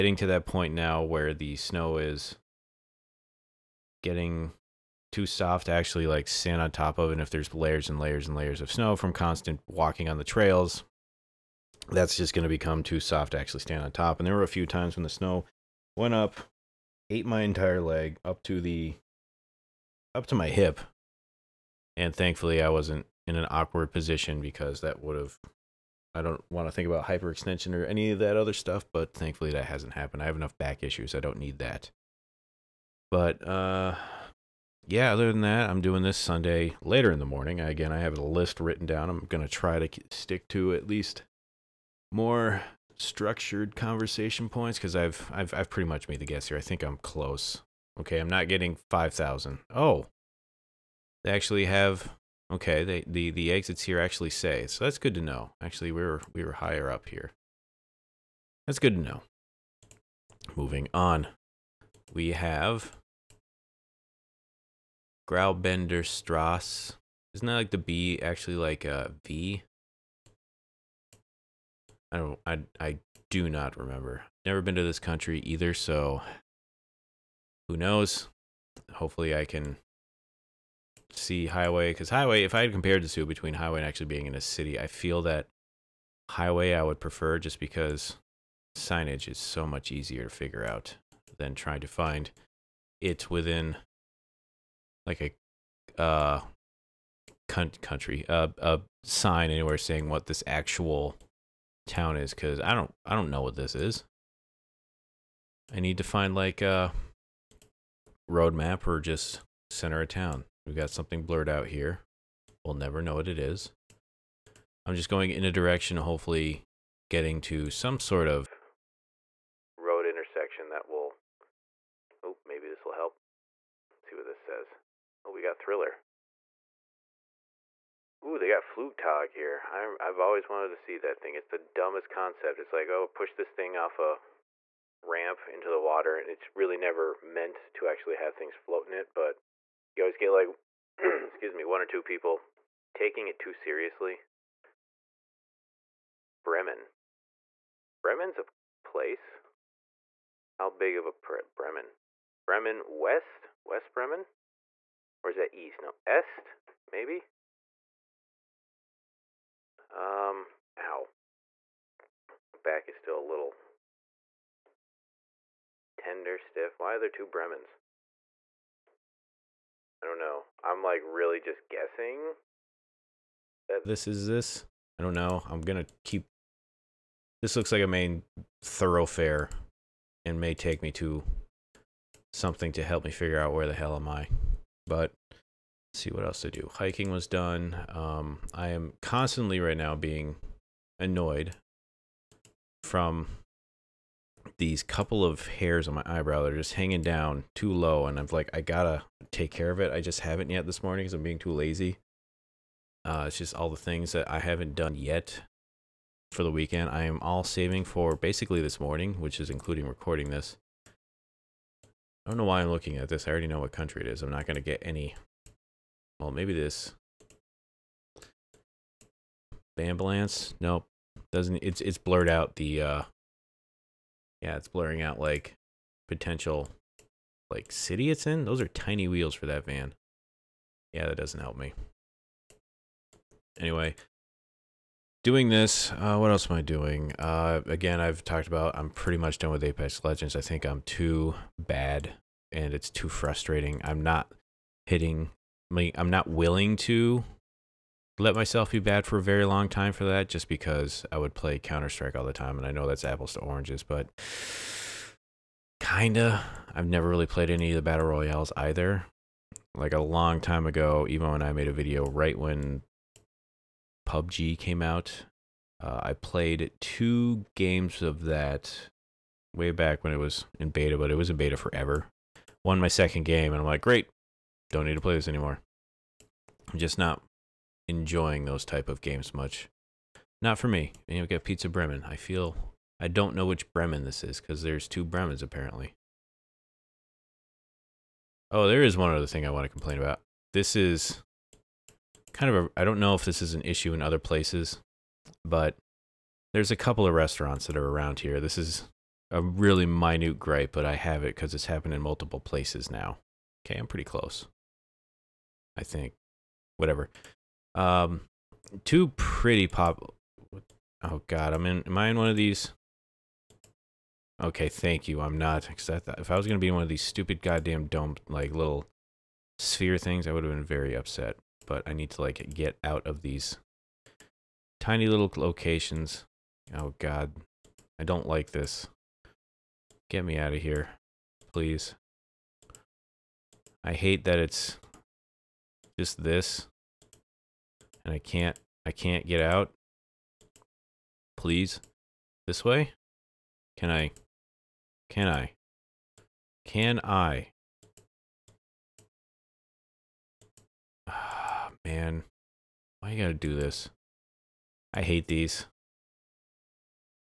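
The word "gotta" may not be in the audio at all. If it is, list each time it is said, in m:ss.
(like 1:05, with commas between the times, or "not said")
3:18, 5:53.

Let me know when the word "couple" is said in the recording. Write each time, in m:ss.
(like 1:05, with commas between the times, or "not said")
3:14, 4:56.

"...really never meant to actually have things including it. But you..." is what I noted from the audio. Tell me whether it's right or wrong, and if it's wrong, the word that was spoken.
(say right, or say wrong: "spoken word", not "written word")
wrong: "floating", not "including".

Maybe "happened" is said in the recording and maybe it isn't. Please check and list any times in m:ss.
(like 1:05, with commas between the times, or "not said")
0:29, 5:01.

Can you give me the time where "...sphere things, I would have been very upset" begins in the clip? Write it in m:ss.
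5:19.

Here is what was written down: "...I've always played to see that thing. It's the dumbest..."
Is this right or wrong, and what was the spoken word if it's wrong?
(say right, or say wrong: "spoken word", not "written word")
wrong: "wanted", not "played".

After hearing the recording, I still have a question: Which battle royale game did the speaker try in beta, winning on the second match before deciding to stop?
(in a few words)
PUBG.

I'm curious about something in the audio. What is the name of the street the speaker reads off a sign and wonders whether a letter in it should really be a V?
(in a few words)
Graubender Strasse.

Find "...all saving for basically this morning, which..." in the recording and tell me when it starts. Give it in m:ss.
3:27.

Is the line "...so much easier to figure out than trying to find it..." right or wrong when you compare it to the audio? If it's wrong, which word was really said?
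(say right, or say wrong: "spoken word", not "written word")
right.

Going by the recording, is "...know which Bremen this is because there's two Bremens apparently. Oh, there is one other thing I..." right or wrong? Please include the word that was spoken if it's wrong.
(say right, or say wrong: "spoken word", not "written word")
right.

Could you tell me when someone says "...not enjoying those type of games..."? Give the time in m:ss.
4:36.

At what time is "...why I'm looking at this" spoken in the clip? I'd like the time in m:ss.
3:32.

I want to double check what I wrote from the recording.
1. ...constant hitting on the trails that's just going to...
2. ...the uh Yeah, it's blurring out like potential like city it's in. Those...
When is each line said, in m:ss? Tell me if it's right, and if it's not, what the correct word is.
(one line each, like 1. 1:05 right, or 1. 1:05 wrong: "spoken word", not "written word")
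1. 0:09 wrong: "walking", not "hitting"
2. 3:42 right.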